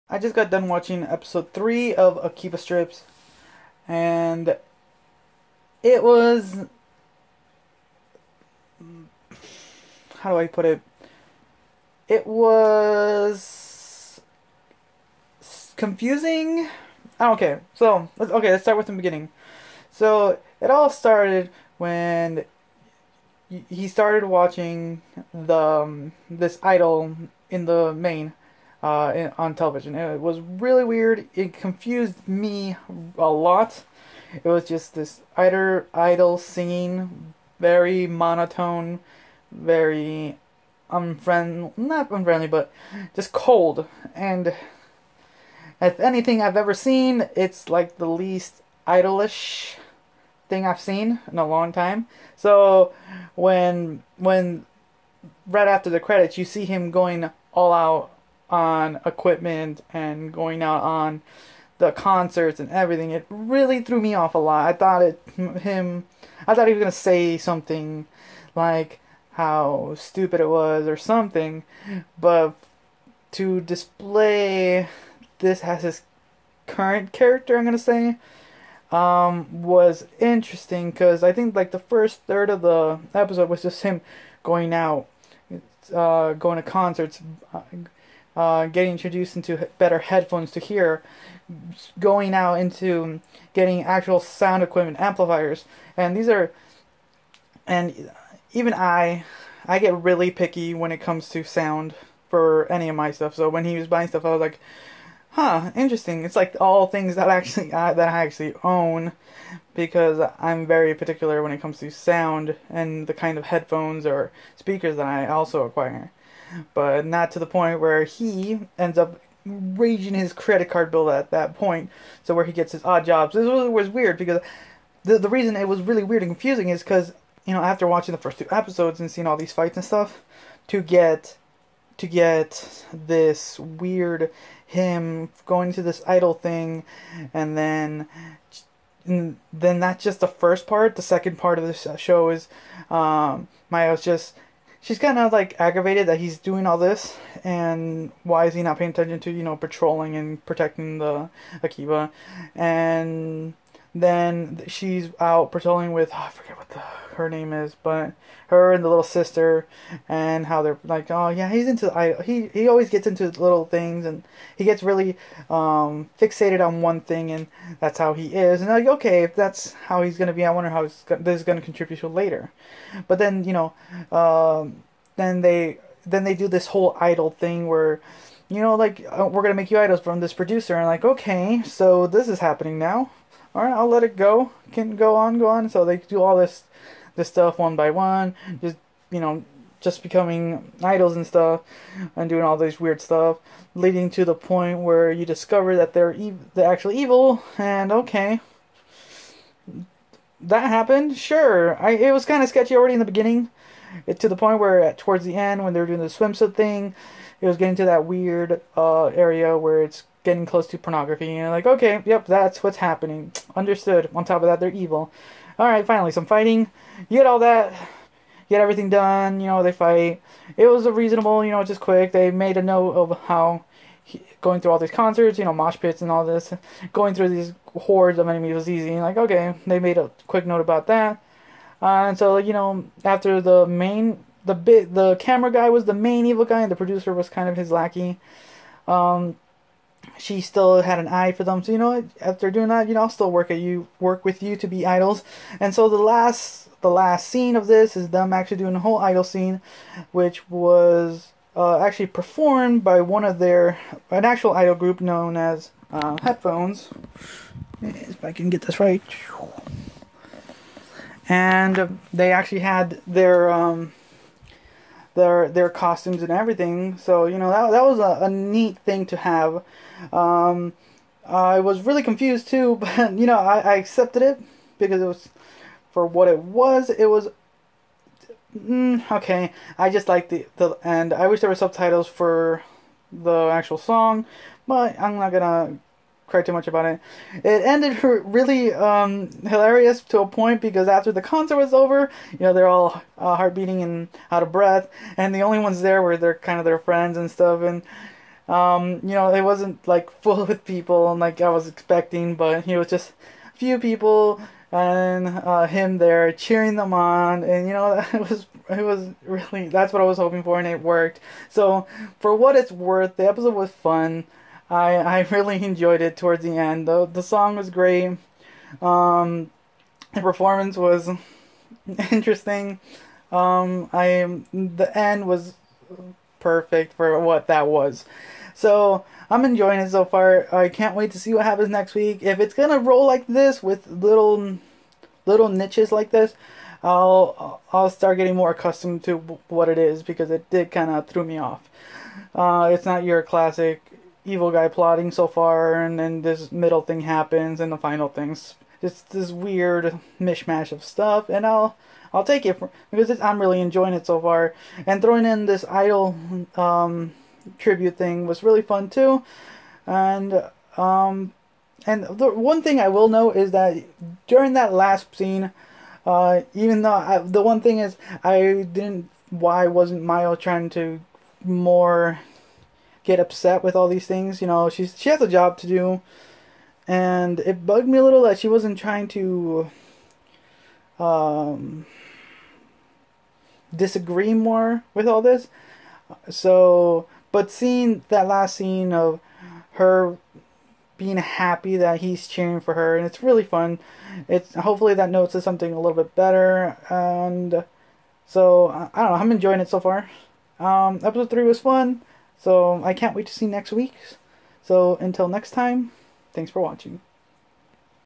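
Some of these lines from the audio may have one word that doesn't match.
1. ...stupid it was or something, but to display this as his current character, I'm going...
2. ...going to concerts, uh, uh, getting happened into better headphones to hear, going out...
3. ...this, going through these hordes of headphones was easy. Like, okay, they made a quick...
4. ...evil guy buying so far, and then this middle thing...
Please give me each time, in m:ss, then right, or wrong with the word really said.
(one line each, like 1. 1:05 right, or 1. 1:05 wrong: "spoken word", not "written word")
1. 1:09 right
2. 1:26 wrong: "introduced", not "happened"
3. 3:46 wrong: "enemies", not "headphones"
4. 5:44 wrong: "plotting", not "buying".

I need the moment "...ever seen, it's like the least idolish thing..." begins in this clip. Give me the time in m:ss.
0:46.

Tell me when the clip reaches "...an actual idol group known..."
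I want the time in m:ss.
4:14.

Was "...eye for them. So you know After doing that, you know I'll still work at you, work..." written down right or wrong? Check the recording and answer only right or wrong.
right.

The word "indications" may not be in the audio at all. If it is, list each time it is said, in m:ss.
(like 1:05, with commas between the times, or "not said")
not said.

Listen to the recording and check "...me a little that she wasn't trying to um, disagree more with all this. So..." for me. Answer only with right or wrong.
right.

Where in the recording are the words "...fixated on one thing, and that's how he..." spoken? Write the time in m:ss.
2:46.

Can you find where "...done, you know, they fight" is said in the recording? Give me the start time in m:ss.
3:38.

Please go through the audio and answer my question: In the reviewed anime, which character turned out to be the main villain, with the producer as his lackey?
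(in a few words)
The camera guy.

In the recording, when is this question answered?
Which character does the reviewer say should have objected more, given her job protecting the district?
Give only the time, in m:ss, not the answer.
6:10.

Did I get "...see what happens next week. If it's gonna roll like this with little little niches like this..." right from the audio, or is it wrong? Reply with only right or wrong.
right.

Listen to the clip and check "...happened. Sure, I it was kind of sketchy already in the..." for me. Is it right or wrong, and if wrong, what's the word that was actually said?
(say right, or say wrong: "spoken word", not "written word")
right.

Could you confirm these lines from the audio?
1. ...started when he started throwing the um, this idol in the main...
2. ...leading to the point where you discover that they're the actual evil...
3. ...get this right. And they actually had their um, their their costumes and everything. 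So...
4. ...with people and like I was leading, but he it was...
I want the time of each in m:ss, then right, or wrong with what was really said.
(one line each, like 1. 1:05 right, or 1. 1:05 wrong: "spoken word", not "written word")
1. 0:20 wrong: "watching", not "throwing"
2. 3:13 right
3. 4:18 right
4. 5:00 wrong: "expecting", not "leading".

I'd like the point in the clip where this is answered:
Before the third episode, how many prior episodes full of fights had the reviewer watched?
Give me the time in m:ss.
2:08.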